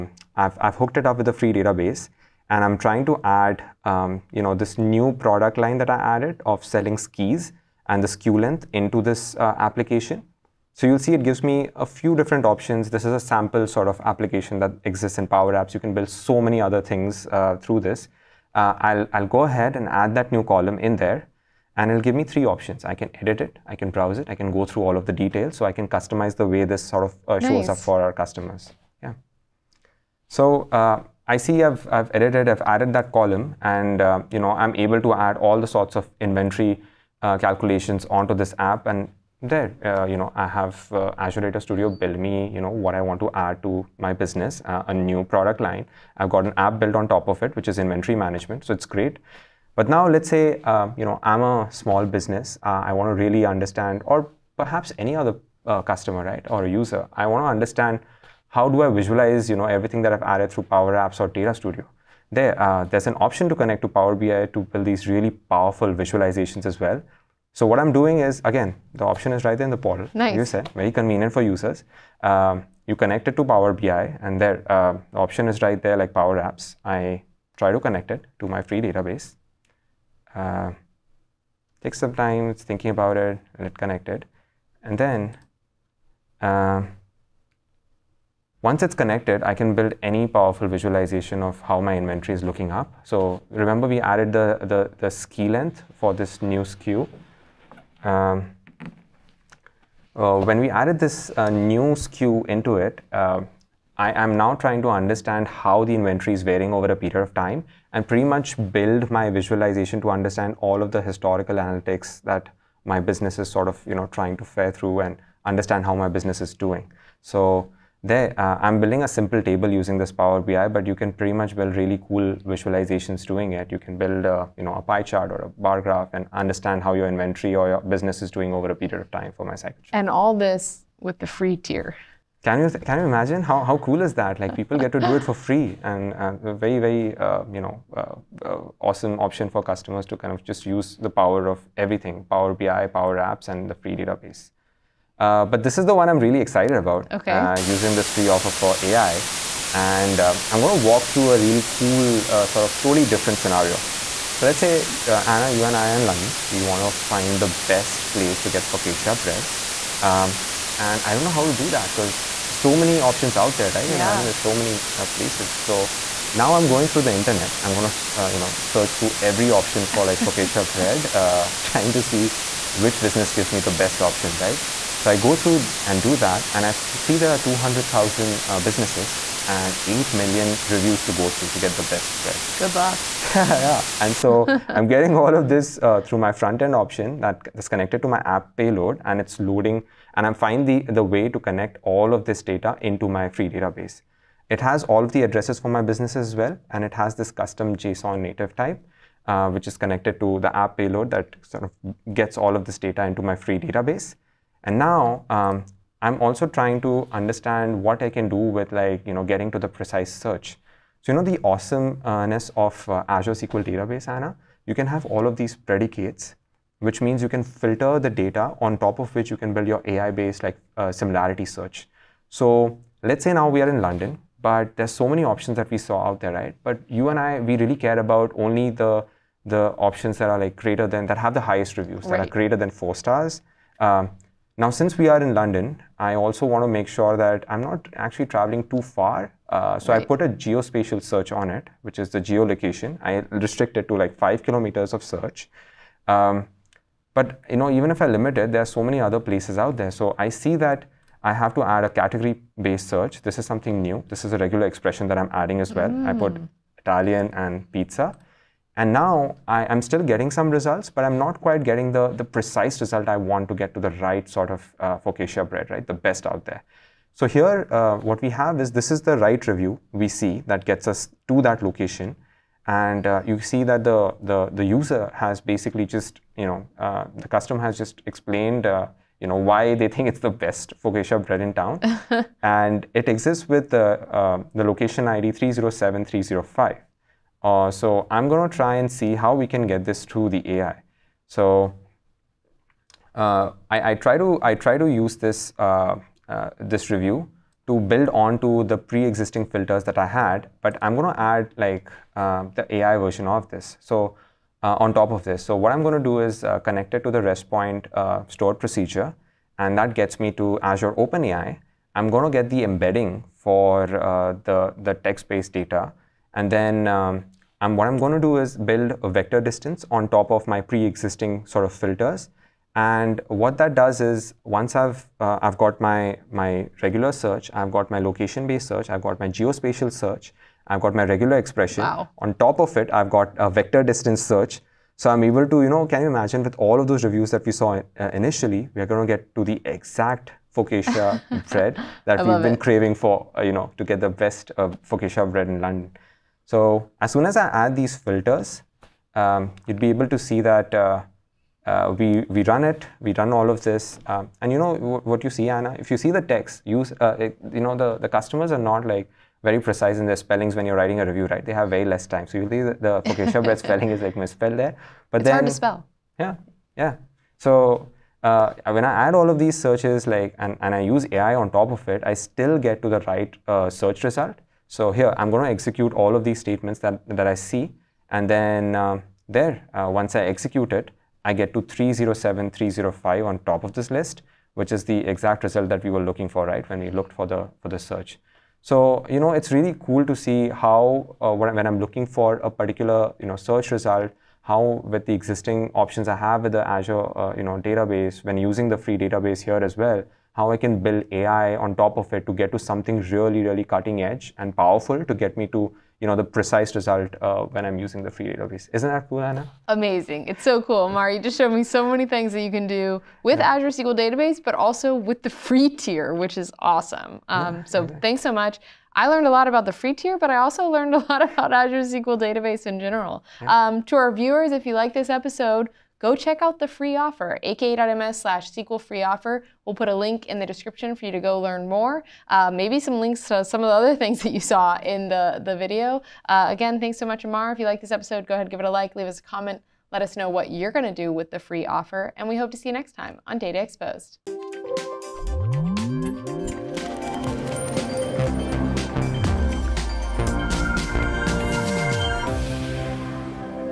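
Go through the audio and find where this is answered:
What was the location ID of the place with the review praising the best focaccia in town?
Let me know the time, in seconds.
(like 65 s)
285 s.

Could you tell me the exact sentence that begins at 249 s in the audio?
So I see that I have to add a category-based search.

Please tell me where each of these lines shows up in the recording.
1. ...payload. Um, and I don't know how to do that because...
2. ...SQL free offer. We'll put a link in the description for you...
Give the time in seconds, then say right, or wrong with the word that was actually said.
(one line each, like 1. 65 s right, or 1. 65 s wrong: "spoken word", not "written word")
1. 159 s wrong: "bread", not "payload"
2. 428 s right.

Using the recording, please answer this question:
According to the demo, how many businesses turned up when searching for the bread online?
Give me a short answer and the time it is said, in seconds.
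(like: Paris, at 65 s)
200,000, at 177 s.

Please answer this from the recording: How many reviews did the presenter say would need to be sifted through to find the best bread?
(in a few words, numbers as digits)
8 million.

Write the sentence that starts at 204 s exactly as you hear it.
And now um, I'm also trying to understand what I can do with like, you know, getting to the precise search.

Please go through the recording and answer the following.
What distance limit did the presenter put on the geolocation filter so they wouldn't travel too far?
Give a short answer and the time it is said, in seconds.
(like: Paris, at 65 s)
5 kilometers, at 244 s.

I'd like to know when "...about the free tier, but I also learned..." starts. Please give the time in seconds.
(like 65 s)
419 s.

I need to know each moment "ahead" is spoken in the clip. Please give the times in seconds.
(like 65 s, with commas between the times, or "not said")
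19 s, 438 s.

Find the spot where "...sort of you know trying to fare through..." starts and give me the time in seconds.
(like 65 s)
113 s.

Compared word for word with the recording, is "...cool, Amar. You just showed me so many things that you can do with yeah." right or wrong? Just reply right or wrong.
right.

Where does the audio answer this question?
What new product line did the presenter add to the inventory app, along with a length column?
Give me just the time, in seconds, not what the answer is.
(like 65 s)
6 s.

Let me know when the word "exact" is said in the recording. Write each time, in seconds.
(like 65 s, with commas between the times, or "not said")
339 s, 384 s.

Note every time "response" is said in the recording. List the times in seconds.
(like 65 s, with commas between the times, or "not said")
not said.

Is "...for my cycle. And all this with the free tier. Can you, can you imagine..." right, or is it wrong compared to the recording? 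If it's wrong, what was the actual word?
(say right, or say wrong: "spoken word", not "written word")
right.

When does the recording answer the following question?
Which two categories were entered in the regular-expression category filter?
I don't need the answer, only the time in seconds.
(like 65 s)
256 s.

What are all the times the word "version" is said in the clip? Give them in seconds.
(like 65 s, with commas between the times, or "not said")
302 s.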